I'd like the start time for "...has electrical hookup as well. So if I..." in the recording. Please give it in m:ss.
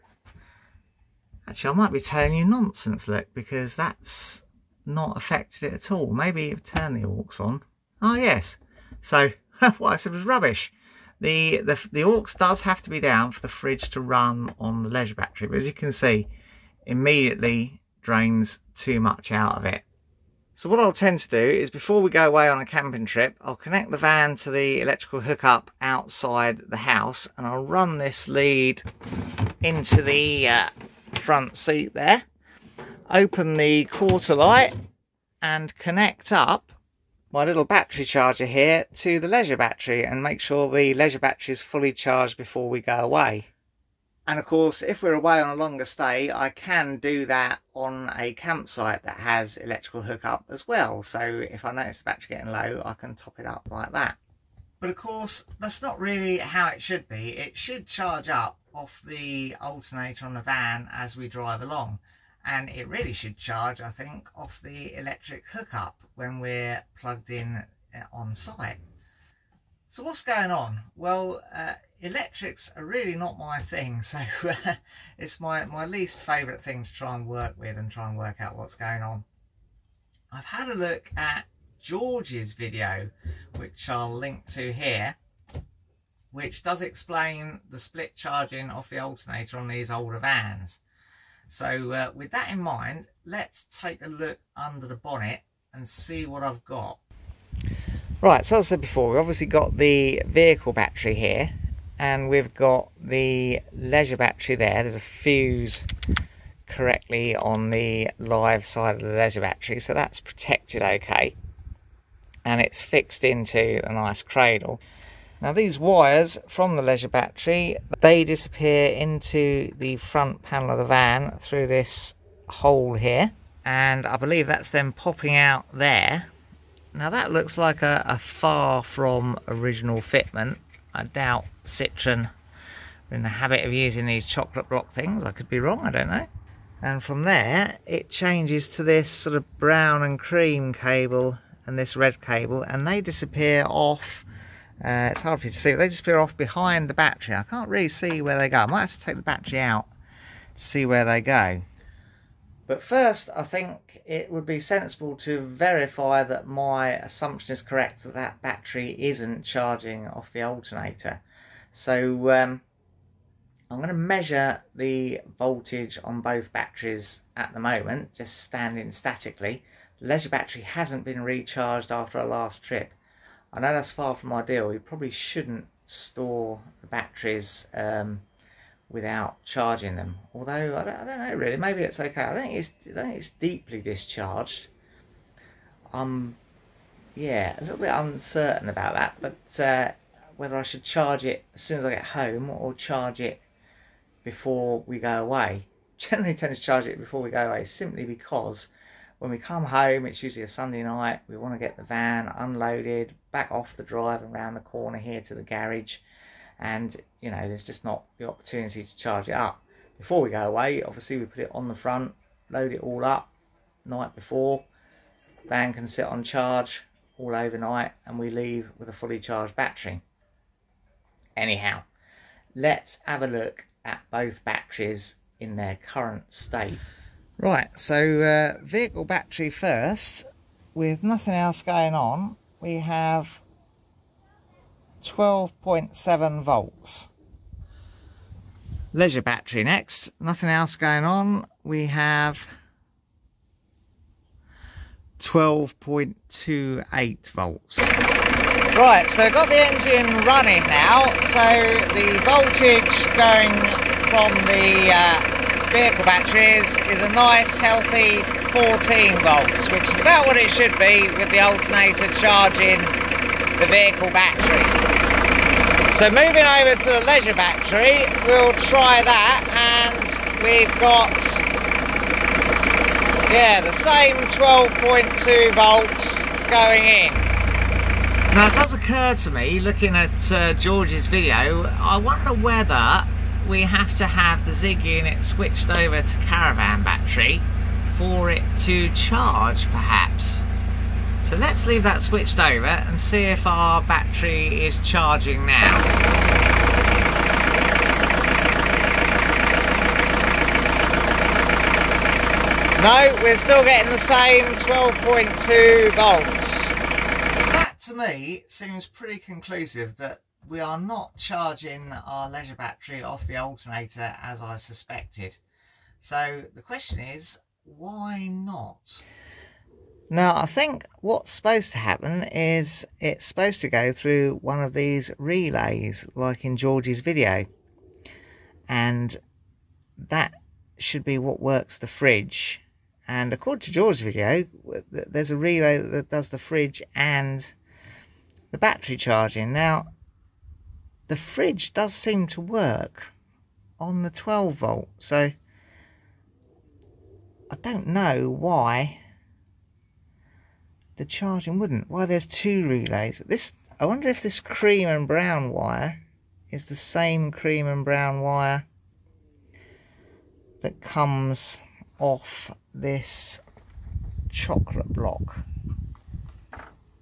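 0:49.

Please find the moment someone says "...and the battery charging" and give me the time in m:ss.
5:36.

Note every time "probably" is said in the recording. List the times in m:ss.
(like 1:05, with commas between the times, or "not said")
2:54.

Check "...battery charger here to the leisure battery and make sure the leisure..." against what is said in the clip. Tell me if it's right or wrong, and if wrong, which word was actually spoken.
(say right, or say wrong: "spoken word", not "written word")
right.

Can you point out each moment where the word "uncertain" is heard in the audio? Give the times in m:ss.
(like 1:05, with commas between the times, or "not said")
3:07.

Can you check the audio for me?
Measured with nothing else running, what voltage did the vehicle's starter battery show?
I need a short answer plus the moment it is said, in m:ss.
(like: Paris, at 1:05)
12.7 volts, at 3:55.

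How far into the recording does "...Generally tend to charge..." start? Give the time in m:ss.
3:15.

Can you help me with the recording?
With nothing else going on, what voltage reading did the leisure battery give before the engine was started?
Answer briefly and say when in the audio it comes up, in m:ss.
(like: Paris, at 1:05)
12.28 volts, at 4:05.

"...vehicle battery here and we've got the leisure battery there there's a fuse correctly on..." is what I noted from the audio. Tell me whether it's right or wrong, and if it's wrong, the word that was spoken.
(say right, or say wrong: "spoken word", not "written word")
right.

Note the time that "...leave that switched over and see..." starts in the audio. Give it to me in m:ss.
4:51.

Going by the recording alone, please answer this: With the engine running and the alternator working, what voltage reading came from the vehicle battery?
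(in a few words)
14 volts.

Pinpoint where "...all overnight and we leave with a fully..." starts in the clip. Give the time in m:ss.
3:37.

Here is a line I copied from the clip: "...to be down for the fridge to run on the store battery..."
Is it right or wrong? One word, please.
wrong.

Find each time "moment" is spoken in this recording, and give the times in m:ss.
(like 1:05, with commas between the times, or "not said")
2:47.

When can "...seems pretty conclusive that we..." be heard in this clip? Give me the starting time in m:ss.
5:08.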